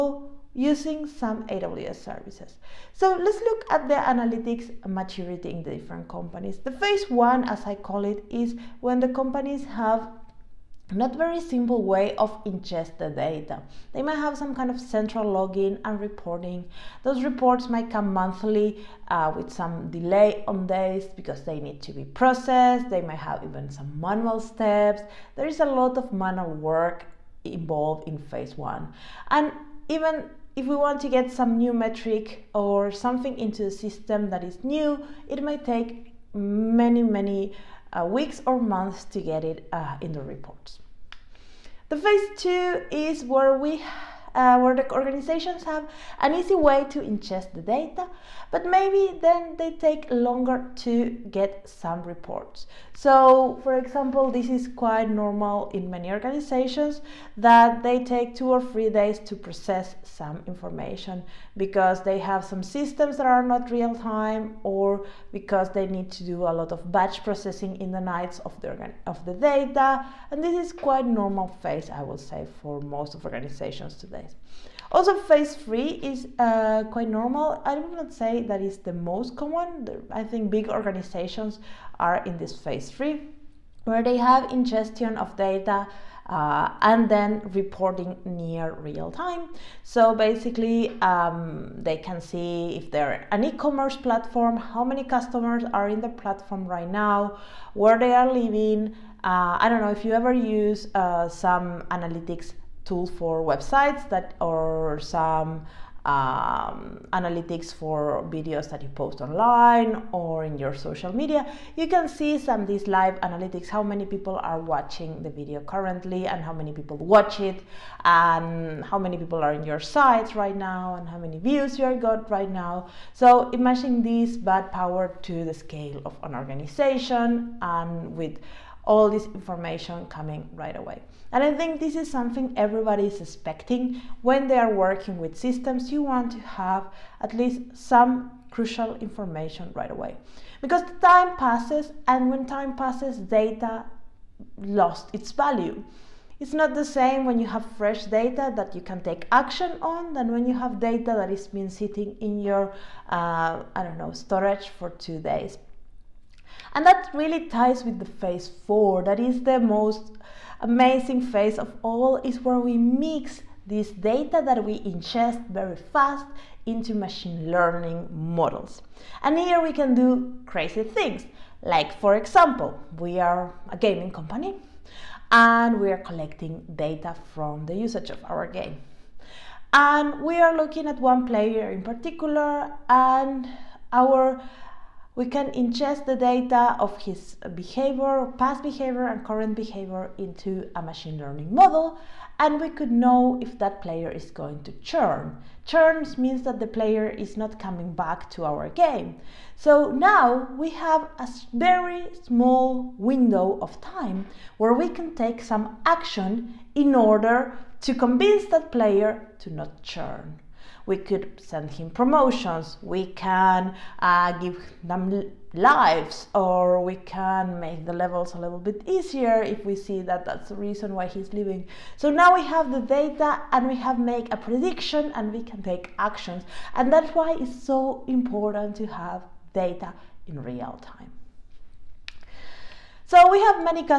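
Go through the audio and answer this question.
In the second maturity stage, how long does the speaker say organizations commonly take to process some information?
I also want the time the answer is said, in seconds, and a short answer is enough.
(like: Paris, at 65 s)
2 or 3 days, at 58 s.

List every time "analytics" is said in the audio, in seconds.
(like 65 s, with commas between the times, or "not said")
3 s, 101 s, 107 s, 113 s.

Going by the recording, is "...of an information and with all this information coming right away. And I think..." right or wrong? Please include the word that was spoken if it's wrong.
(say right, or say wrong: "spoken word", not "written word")
wrong: "organization", not "information".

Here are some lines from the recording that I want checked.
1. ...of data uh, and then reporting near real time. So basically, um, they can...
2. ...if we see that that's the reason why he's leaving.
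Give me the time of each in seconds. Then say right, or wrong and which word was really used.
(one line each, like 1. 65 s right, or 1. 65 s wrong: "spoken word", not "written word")
1. 85 s right
2. 219 s right.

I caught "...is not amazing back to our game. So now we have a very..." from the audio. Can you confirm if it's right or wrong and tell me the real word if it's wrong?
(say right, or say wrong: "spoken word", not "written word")
wrong: "coming", not "amazing".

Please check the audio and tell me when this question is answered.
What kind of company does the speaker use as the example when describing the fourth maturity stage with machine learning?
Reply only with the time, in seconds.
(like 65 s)
173 s.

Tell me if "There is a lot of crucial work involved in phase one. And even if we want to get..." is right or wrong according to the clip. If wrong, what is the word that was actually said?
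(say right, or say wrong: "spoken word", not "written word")
wrong: "manual", not "crucial".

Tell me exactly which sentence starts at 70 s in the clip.
And this is quite normal phase, I would say, for most of organizations today.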